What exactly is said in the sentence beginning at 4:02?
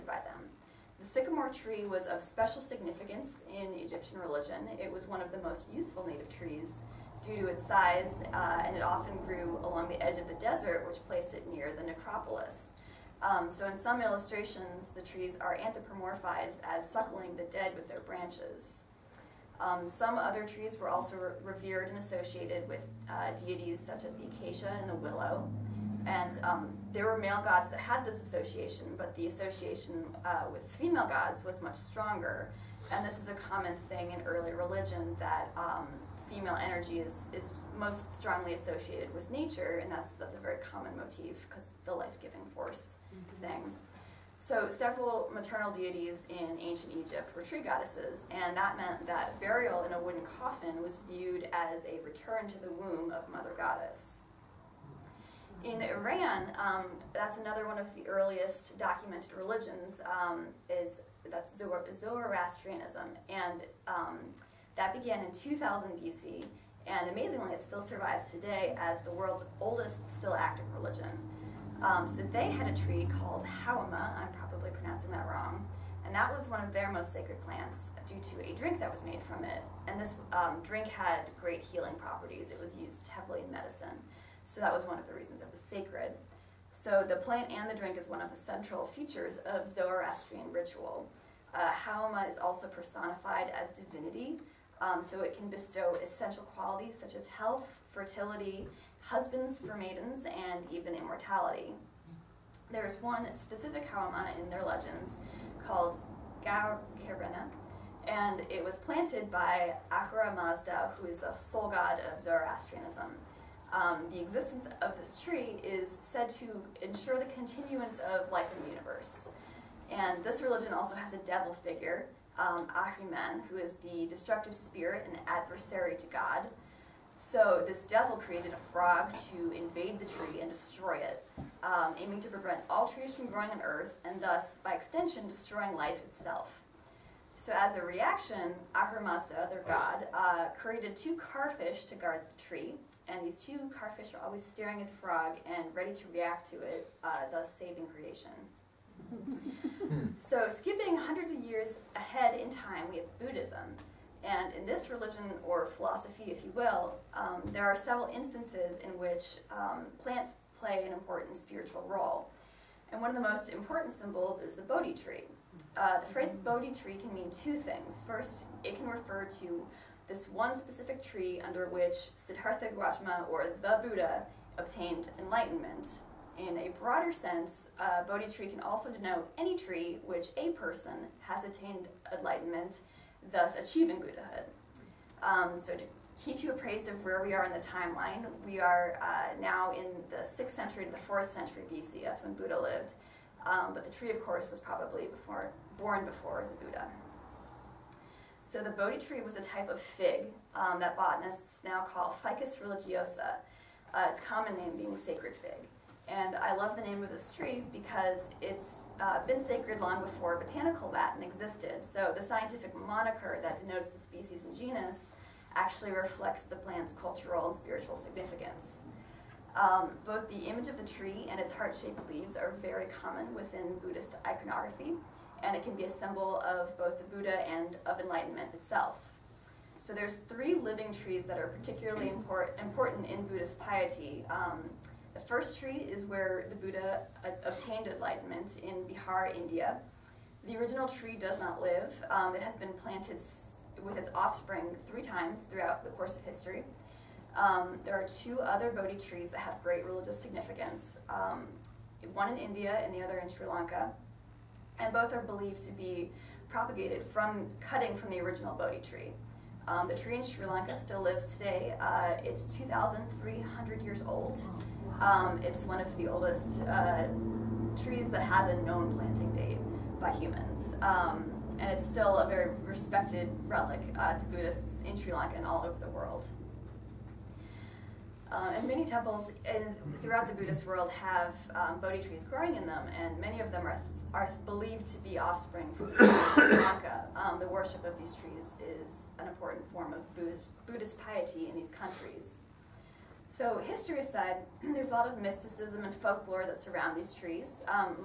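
Um, it has been planted with its offspring three times throughout the course of history.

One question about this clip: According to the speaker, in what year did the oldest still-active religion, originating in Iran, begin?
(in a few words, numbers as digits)
2000 BC.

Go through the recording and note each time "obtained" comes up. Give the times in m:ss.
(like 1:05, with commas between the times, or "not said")
2:54, 3:57.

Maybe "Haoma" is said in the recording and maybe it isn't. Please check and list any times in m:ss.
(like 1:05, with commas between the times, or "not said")
1:31, 1:43.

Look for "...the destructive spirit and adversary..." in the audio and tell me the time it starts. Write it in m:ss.
2:03.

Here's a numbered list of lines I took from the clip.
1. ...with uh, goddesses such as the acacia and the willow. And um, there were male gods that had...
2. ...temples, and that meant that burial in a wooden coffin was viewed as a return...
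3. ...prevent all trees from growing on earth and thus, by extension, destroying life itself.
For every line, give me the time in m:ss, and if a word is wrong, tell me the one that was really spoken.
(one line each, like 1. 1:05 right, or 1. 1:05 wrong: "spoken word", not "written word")
1. 0:22 wrong: "deities", not "goddesses"
2. 0:47 wrong: "goddesses", not "temples"
3. 2:12 right.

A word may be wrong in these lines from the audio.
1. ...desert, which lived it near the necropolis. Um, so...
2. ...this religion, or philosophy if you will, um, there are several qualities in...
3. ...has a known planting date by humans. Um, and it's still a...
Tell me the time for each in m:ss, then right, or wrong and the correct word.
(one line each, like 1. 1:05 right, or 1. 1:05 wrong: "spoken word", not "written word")
1. 0:10 wrong: "placed", not "lived"
2. 2:34 wrong: "instances", not "qualities"
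3. 4:28 right.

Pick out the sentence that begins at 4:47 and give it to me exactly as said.
Um, the worship of these trees is an important form of Buddhist, Buddhist piety in these countries.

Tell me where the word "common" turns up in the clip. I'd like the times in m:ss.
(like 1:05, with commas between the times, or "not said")
0:33, 0:40, 3:24, 3:42.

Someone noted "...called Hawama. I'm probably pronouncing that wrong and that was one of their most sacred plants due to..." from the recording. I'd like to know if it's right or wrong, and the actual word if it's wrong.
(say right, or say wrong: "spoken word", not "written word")
right.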